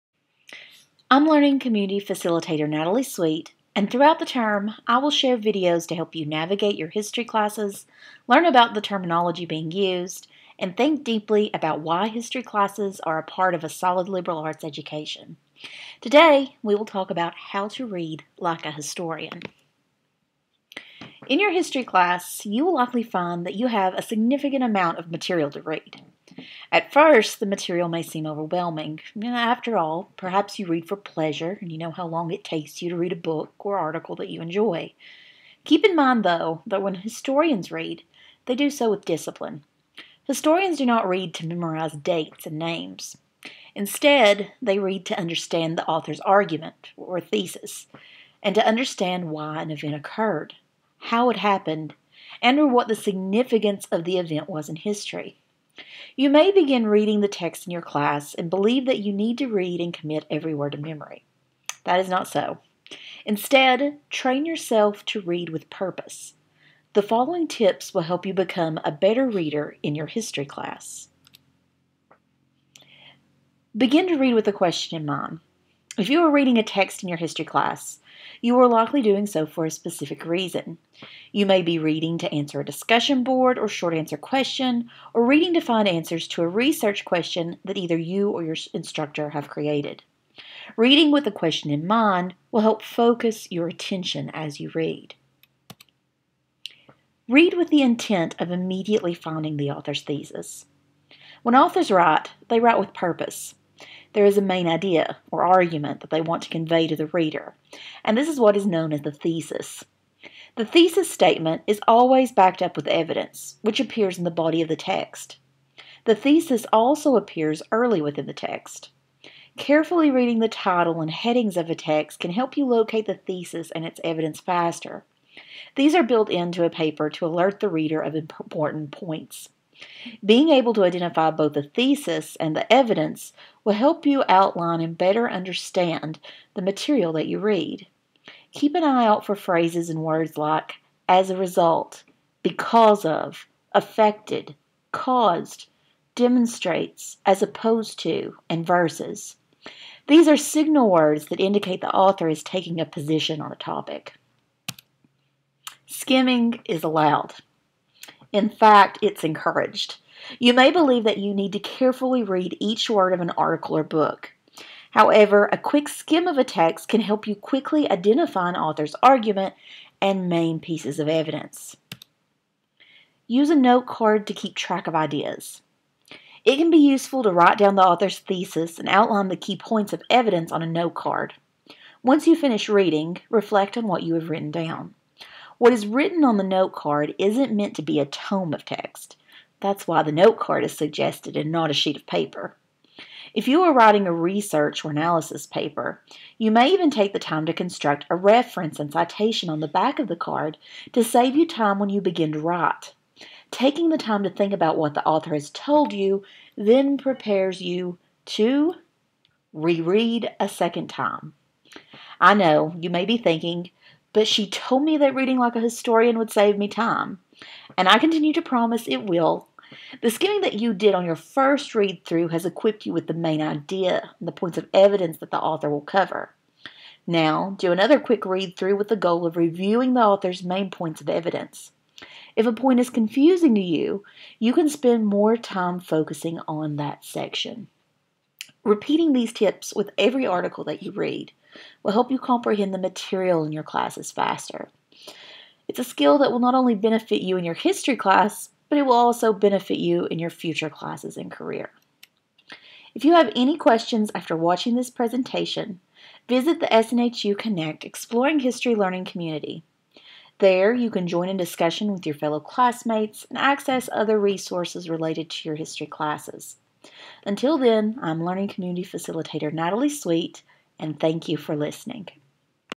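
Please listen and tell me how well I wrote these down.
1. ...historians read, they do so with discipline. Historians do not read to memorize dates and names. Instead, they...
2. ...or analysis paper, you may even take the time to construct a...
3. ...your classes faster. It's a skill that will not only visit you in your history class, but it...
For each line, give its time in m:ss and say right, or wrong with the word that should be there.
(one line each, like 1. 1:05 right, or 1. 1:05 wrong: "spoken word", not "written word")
1. 0:36 right
2. 3:14 right
3. 4:03 wrong: "benefit", not "visit".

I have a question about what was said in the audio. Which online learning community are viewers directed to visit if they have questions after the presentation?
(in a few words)
SNHU Connect Exploring History.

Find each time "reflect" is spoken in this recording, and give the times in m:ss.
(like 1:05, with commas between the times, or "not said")
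3:03.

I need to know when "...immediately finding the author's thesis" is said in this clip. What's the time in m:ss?
1:38.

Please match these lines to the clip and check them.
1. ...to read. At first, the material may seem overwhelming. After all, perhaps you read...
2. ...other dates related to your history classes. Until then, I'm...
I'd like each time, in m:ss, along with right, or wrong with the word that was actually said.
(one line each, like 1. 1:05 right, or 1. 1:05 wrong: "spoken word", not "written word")
1. 0:25 right
2. 4:23 wrong: "resources", not "dates".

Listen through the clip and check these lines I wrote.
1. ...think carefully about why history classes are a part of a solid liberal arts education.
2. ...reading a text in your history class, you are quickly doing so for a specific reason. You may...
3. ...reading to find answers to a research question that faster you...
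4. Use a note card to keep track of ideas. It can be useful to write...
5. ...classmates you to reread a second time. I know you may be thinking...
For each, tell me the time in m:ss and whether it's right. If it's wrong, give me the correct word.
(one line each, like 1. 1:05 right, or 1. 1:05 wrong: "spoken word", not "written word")
1. 0:10 wrong: "deeply", not "carefully"
2. 1:16 wrong: "likely", not "quickly"
3. 1:25 wrong: "either", not "faster"
4. 2:53 right
5. 3:26 wrong: "prepares", not "classmates".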